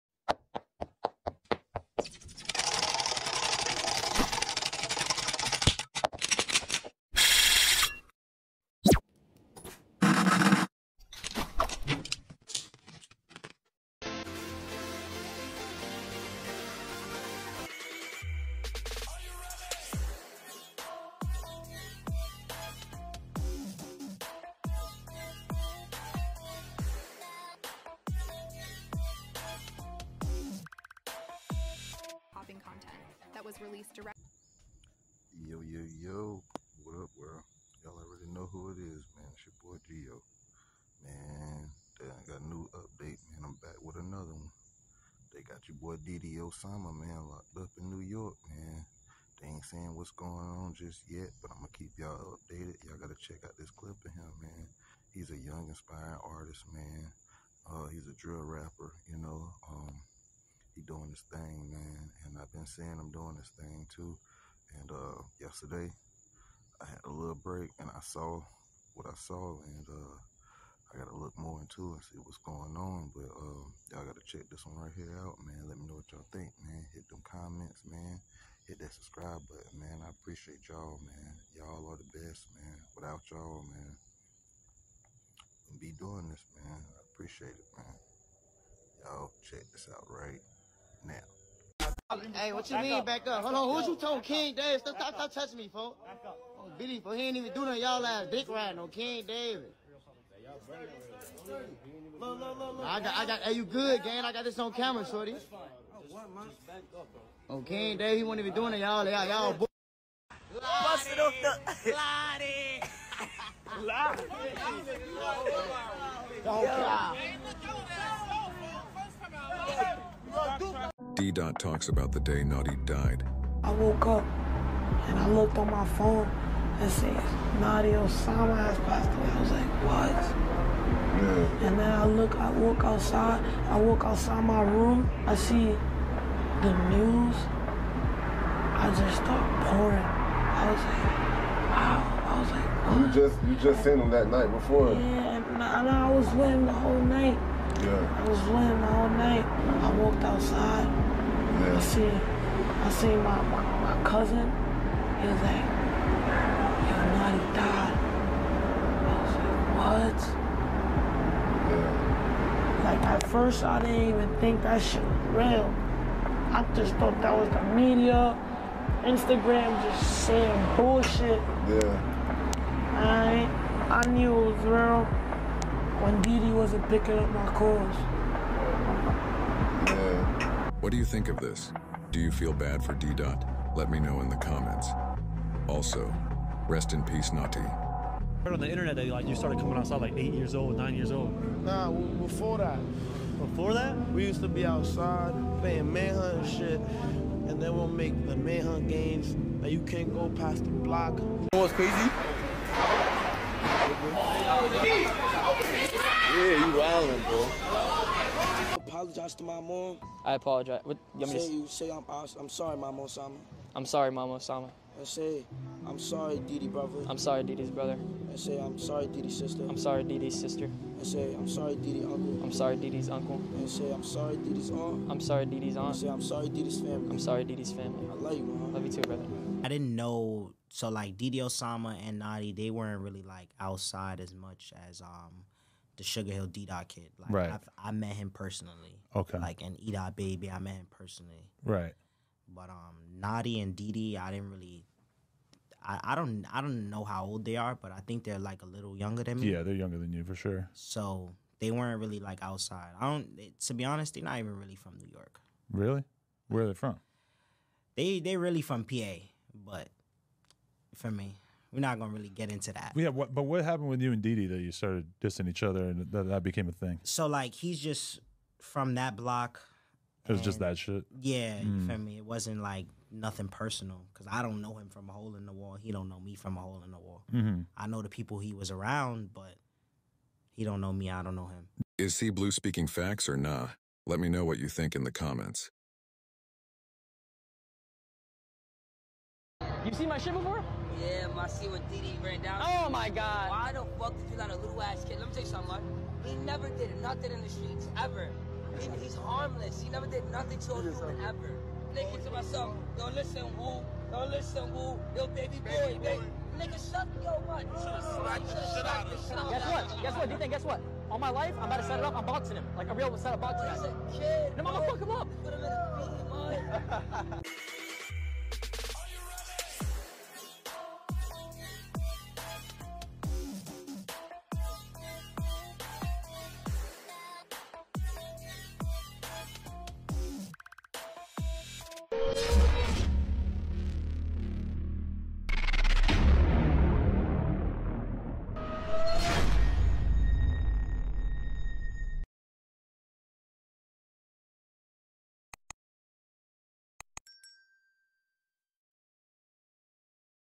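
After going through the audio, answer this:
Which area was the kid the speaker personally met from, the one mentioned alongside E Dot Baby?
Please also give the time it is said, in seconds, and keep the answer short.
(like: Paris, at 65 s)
Sugar Hill, at 236 s.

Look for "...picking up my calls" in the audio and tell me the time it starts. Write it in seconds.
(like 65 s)
176 s.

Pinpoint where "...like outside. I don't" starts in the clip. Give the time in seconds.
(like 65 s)
252 s.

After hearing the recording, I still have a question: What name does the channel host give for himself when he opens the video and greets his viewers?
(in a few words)
Geo.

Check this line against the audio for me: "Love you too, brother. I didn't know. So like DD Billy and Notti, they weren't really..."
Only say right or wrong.
wrong.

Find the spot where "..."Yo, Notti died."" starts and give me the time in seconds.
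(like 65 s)
156 s.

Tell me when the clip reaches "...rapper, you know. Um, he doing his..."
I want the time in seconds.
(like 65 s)
58 s.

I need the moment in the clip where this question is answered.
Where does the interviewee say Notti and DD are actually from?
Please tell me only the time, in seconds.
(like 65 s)
258 s.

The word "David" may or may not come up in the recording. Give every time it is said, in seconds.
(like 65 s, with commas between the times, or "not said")
94 s, 99 s, 107 s.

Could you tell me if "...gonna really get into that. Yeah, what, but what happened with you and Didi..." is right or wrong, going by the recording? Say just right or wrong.
right.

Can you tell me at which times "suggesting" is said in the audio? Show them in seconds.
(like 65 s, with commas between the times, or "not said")
not said.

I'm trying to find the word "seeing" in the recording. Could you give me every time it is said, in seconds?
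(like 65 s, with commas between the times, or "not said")
62 s.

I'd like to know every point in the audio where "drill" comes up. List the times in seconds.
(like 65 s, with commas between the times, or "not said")
58 s.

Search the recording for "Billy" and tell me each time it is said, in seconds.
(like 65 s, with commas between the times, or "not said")
96 s.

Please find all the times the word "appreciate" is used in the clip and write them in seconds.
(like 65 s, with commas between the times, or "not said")
80 s, 87 s.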